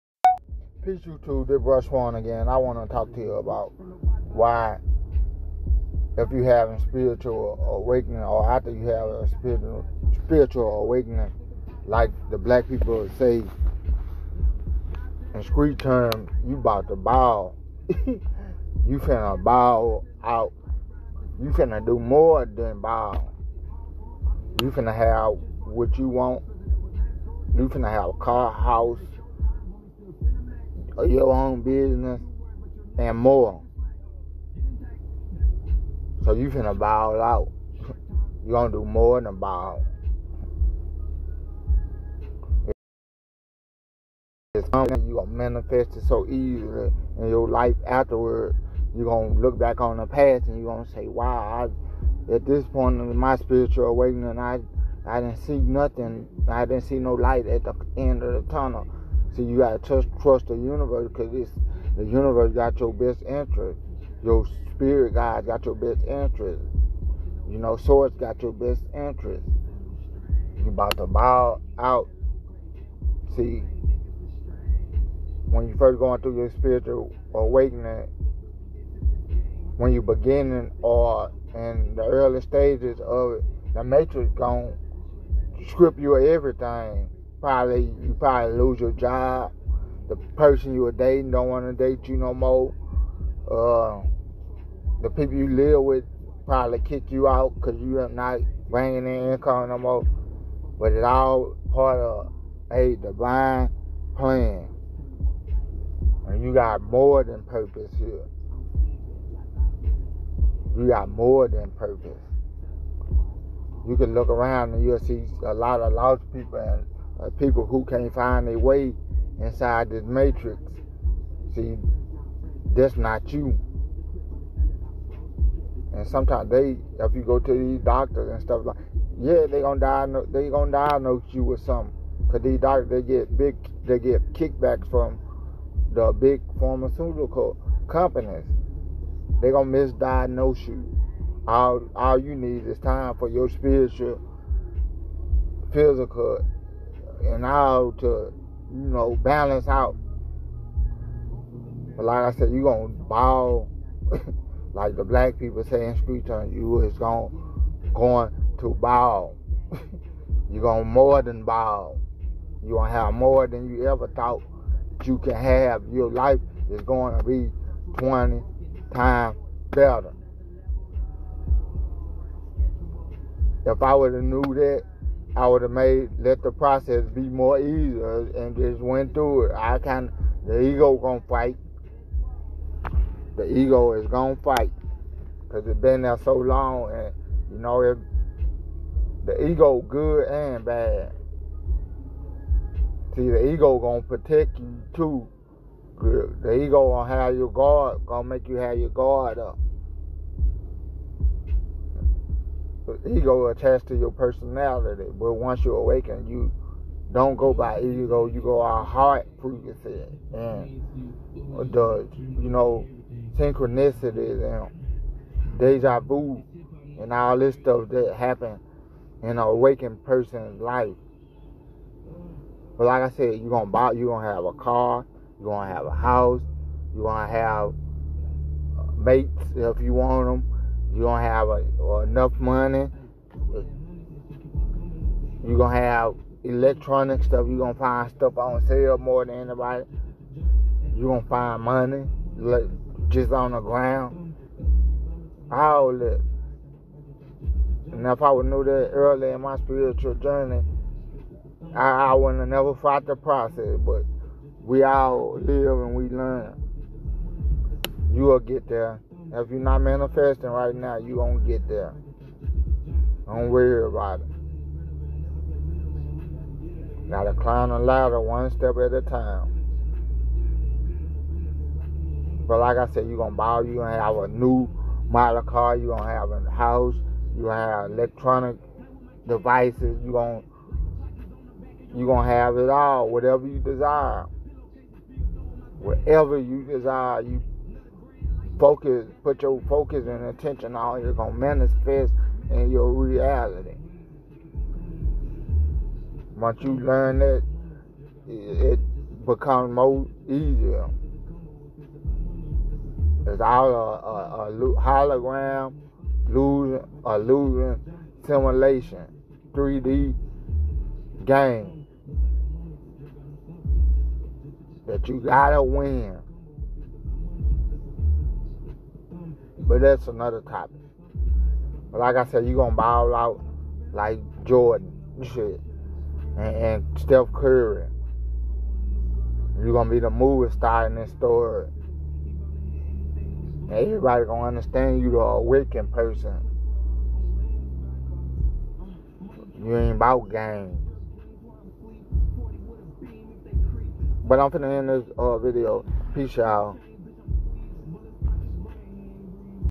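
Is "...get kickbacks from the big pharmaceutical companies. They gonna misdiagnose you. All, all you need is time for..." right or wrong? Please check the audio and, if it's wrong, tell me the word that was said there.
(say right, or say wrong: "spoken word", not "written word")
right.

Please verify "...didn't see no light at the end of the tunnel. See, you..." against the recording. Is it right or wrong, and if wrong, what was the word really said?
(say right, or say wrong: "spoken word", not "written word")
right.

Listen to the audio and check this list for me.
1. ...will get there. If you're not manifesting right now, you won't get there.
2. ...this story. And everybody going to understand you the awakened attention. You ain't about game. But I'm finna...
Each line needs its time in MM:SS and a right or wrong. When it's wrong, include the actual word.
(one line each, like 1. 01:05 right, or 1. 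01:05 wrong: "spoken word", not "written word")
1. 04:18 right
2. 05:30 wrong: "person", not "attention".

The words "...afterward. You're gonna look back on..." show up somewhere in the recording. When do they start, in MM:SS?
00:47.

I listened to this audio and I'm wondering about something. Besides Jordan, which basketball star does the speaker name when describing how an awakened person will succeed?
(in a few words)
Steph Curry.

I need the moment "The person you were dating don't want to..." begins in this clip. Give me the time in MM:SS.
01:30.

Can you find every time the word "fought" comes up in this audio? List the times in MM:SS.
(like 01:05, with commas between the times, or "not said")
04:12.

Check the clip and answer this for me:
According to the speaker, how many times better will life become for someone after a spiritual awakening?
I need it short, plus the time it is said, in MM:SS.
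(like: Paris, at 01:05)
20 times, at 02:47.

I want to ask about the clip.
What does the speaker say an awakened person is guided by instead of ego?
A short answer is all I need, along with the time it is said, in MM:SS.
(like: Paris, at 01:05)
Heart frequency, at 03:28.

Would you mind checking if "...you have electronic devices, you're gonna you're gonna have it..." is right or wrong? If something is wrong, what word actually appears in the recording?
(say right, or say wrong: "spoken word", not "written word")
right.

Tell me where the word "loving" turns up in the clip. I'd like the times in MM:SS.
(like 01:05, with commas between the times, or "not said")
not said.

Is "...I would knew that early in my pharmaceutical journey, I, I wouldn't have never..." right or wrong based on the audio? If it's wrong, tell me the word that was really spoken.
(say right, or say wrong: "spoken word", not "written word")
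wrong: "spiritual", not "pharmaceutical".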